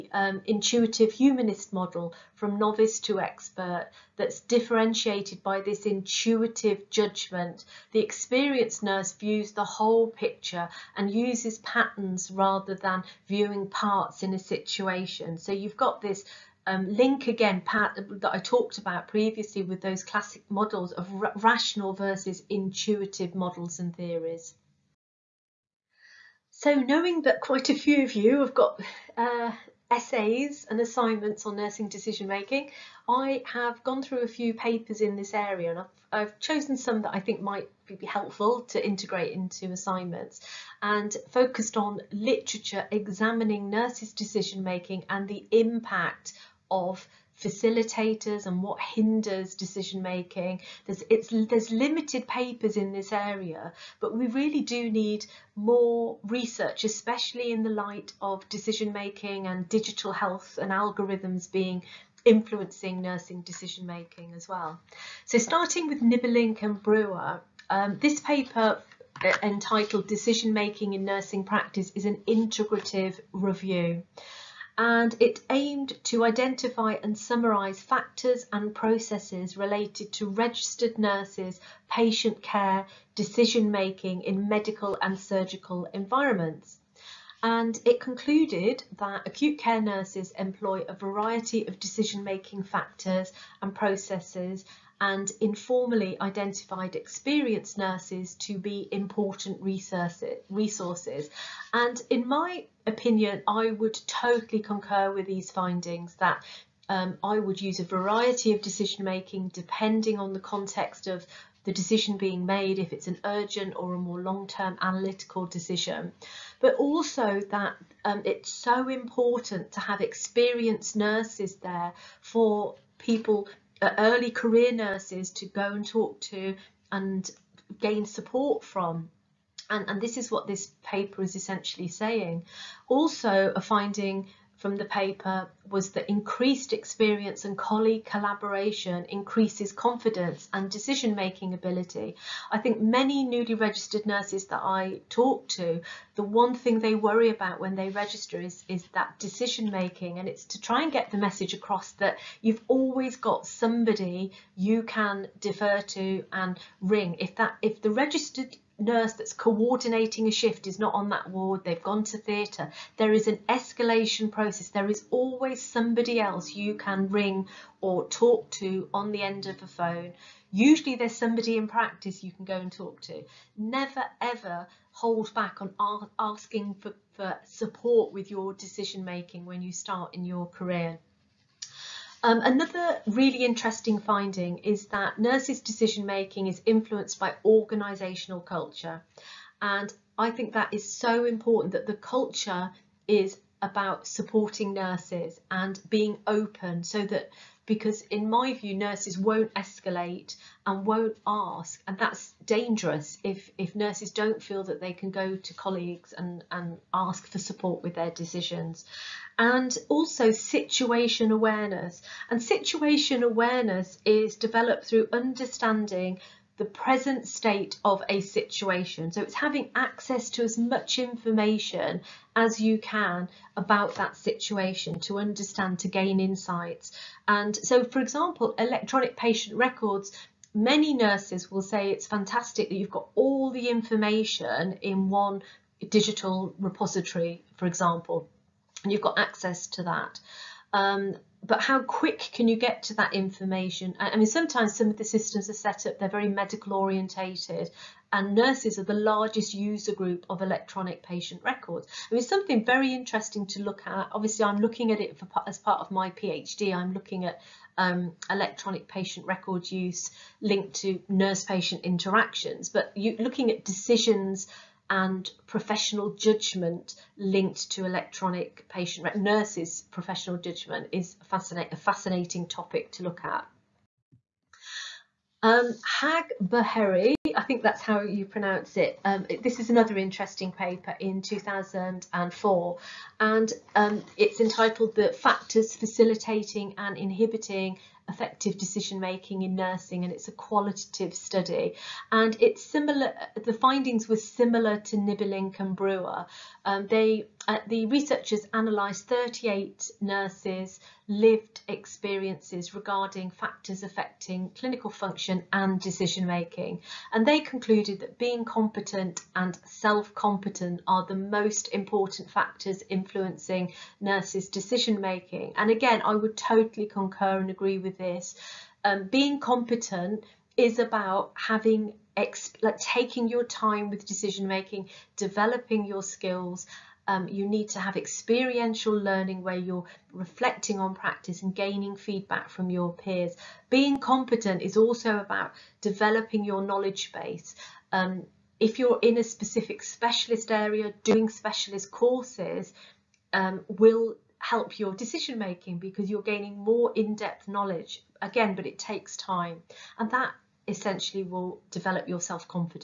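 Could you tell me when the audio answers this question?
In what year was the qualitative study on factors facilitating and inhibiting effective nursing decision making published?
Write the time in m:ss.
4:41.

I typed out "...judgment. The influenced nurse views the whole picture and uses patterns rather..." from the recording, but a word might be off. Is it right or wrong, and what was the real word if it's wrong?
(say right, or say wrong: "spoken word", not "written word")
wrong: "experienced", not "influenced".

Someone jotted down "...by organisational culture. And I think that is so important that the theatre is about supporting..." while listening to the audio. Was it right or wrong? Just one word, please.
wrong.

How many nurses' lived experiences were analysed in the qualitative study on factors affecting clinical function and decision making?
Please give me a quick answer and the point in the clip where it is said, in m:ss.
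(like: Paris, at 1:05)
38, at 4:59.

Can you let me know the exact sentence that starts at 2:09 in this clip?
And, and this is what this paper is essentially saying.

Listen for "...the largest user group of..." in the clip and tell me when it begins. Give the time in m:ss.
4:08.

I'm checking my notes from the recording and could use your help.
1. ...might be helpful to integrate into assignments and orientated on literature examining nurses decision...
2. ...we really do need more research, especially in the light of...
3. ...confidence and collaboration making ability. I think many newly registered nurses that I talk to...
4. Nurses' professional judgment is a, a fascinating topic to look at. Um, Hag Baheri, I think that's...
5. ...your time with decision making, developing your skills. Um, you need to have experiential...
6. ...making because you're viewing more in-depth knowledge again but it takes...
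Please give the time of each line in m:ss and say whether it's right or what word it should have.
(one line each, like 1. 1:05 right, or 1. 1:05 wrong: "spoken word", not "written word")
1. 0:37 wrong: "focused", not "orientated"
2. 0:54 right
3. 2:19 wrong: "decision", not "collaboration"
4. 4:29 right
5. 5:23 right
6. 5:45 wrong: "gaining", not "viewing".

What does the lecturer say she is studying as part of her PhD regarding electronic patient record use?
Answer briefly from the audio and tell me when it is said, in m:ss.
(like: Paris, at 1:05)
Nurse-patient interactions, at 4:21.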